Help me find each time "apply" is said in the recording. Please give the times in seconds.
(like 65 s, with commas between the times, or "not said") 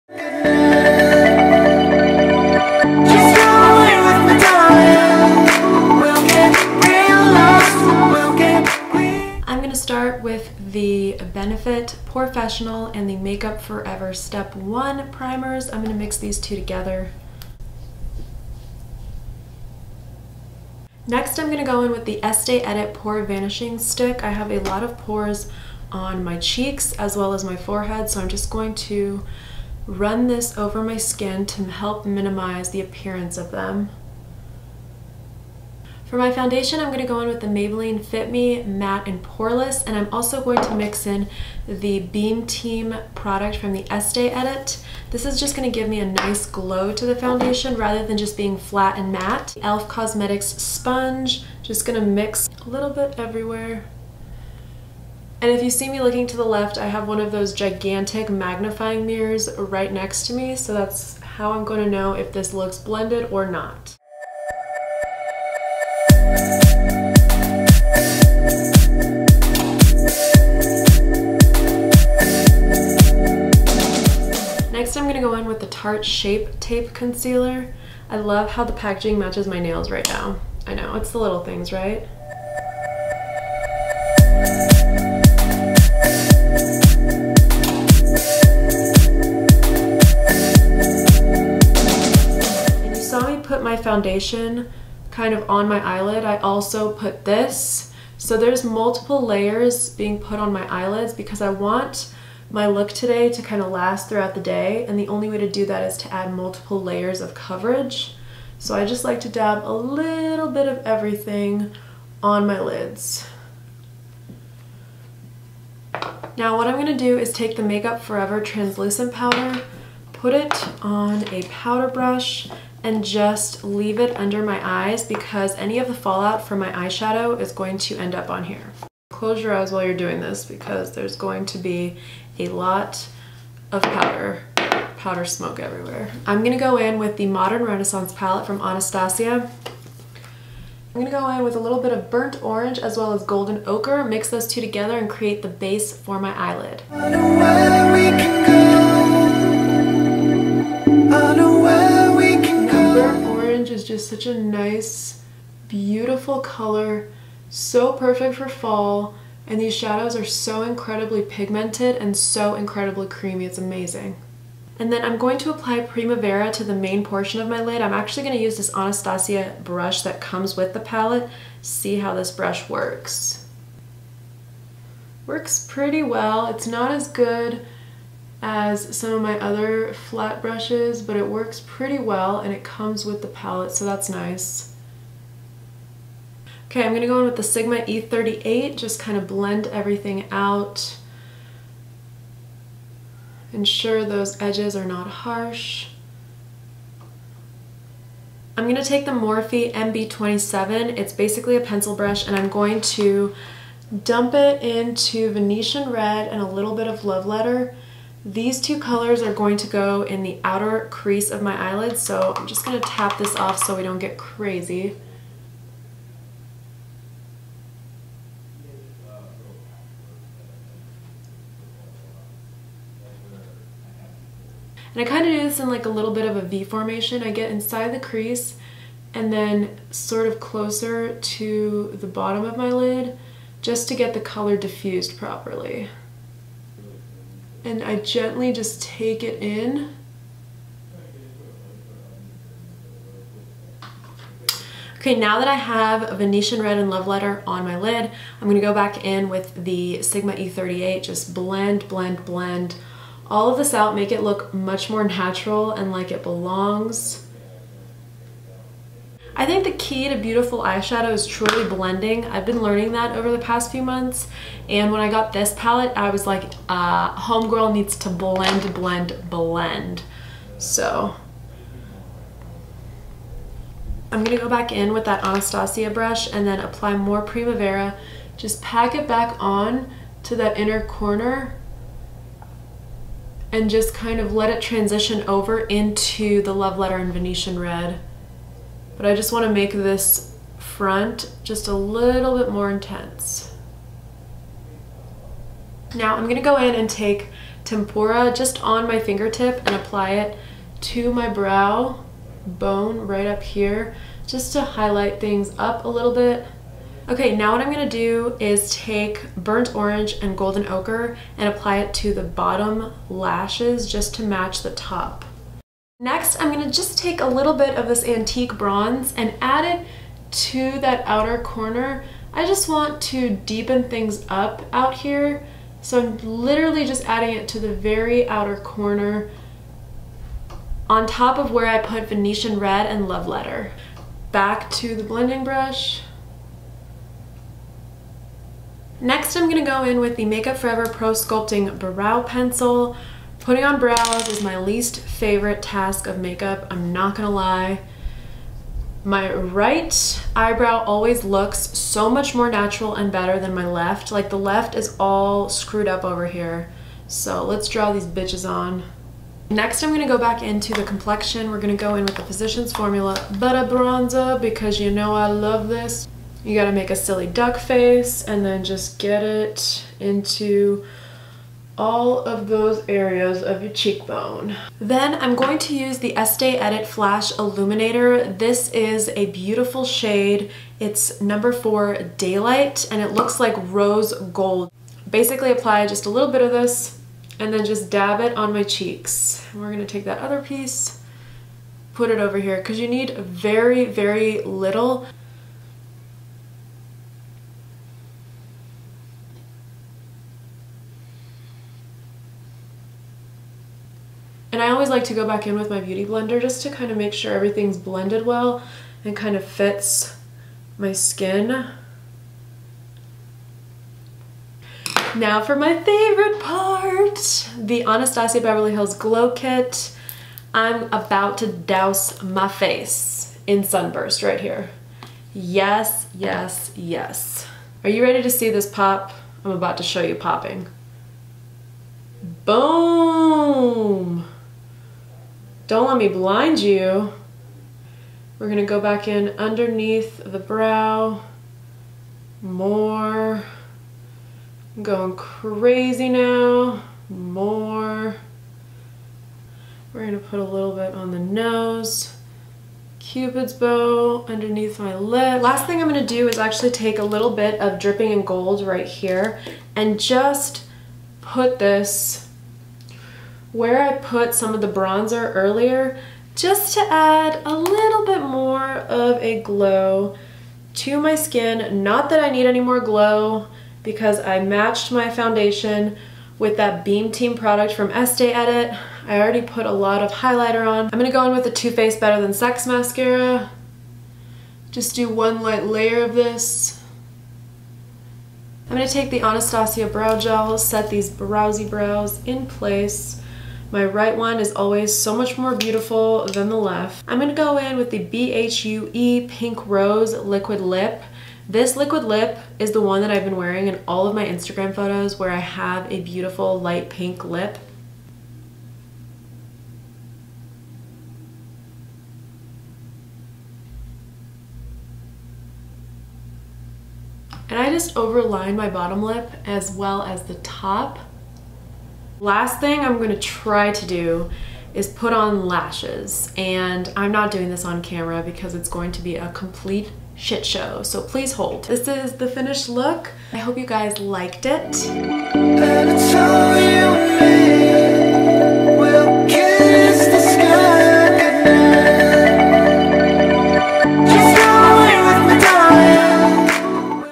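165 s, 276 s, 299 s, 311 s, 385 s.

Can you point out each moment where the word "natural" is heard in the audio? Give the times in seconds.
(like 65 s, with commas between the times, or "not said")
255 s, 352 s.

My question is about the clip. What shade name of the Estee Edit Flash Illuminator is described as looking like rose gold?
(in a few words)
Daylight.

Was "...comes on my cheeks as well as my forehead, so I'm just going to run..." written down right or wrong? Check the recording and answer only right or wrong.
wrong.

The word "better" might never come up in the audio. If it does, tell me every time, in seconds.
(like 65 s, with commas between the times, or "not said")
353 s, 481 s.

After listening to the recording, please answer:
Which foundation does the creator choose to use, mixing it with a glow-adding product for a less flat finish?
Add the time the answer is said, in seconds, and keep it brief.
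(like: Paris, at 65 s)
Maybelline Fit Me Matte and Poreless, at 37 s.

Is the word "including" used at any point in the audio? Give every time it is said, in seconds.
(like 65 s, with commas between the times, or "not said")
not said.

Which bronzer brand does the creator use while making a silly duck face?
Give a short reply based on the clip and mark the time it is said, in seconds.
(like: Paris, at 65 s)
Physicians Formula Butter Bronzer, at 362 s.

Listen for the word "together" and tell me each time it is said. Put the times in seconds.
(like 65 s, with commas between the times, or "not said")
16 s, 144 s.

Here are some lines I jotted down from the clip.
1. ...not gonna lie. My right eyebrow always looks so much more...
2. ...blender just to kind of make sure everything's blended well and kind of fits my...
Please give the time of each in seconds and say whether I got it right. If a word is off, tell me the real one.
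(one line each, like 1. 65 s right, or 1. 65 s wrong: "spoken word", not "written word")
1. 346 s right
2. 406 s right.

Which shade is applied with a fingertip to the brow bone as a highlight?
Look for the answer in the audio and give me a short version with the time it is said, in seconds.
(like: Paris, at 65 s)
Tempera, at 297 s.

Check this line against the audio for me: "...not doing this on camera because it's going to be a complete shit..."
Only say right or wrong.
right.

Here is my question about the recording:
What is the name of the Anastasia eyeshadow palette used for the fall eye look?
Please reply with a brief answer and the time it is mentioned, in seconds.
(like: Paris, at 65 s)
Modern Renaissance, at 137 s.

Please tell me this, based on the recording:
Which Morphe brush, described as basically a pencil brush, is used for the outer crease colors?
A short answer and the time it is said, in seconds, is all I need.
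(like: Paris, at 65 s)
MB27, at 199 s.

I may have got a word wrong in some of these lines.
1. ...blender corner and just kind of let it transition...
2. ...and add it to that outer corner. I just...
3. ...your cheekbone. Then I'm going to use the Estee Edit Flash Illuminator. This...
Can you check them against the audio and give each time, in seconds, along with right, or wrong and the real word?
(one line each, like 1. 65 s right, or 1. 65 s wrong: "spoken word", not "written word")
1. 280 s wrong: "inner", not "blender"
2. 319 s right
3. 373 s right.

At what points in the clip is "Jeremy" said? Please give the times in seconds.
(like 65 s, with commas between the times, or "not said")
not said.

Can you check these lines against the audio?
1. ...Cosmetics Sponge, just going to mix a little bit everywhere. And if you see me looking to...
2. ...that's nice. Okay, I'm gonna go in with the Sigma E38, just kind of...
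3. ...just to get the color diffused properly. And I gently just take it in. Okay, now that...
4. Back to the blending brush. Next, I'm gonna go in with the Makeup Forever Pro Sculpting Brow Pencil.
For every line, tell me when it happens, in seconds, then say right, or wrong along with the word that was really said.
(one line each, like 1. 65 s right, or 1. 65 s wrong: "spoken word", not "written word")
1. 49 s right
2. 183 s right
3. 233 s right
4. 334 s right.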